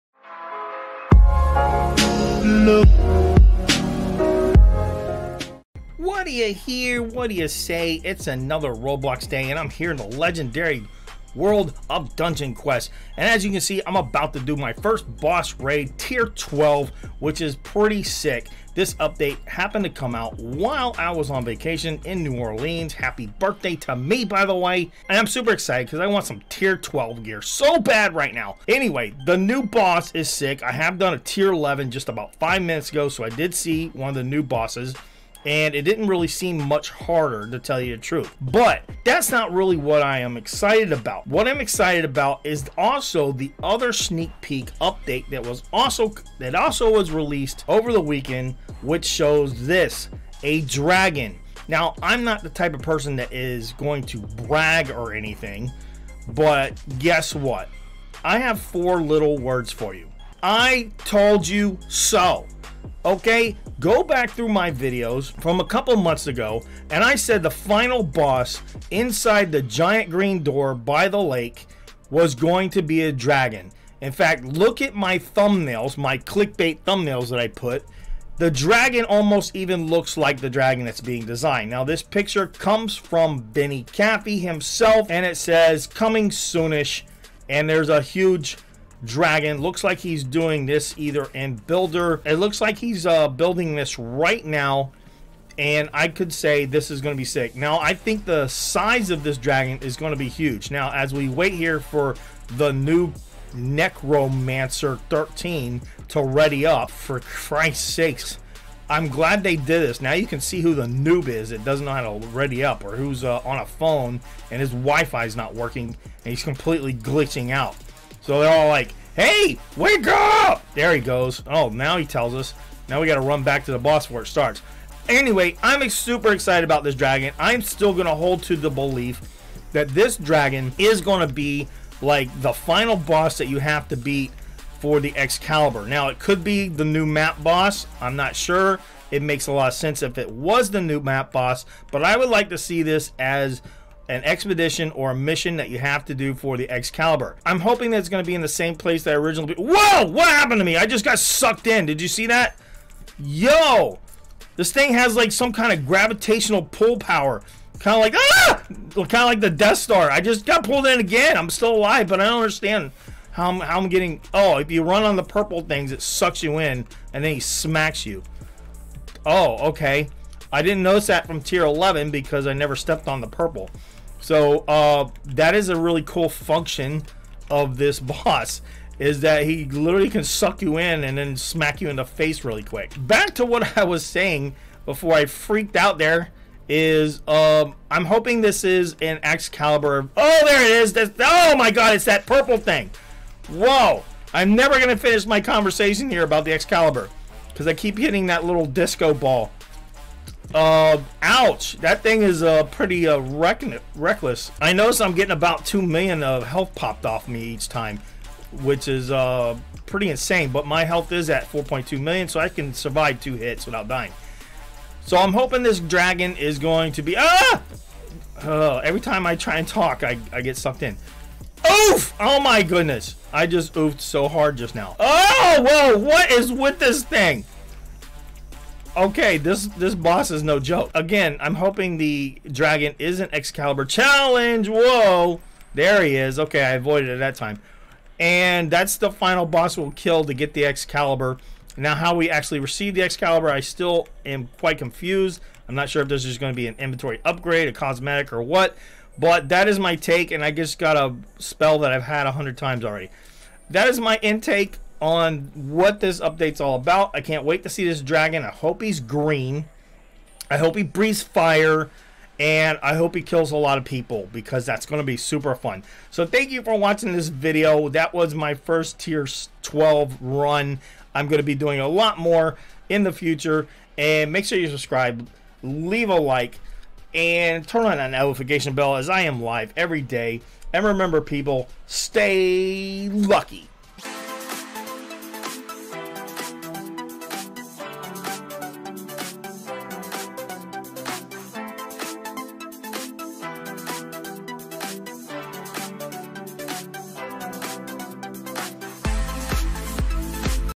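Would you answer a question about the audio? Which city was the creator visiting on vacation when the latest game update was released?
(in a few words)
New Orleans.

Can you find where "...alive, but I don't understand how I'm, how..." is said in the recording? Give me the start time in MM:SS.
02:41.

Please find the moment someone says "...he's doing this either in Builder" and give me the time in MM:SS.
01:29.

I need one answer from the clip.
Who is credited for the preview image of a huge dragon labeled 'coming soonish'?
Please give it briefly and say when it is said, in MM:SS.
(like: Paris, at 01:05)
Benny Caffey, at 01:23.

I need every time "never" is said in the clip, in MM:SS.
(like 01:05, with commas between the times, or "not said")
02:52, 03:14.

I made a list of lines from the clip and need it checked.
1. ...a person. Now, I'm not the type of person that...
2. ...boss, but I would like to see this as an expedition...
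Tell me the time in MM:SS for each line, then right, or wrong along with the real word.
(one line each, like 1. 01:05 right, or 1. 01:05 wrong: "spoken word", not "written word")
1. 00:50 wrong: "dragon", not "person"
2. 02:21 right.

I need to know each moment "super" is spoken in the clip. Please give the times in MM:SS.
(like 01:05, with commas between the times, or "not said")
00:25, 02:05, 04:25.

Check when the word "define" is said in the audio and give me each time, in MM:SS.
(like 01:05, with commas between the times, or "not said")
not said.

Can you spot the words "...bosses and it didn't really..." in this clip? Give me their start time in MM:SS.
00:34.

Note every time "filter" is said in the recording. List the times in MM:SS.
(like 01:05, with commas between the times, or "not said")
not said.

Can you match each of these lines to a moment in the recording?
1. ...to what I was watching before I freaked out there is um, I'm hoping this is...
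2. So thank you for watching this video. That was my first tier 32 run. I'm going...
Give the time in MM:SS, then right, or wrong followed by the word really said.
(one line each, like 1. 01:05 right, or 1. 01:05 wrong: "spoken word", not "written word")
1. 03:03 wrong: "saying", not "watching"
2. 04:26 wrong: "12", not "32".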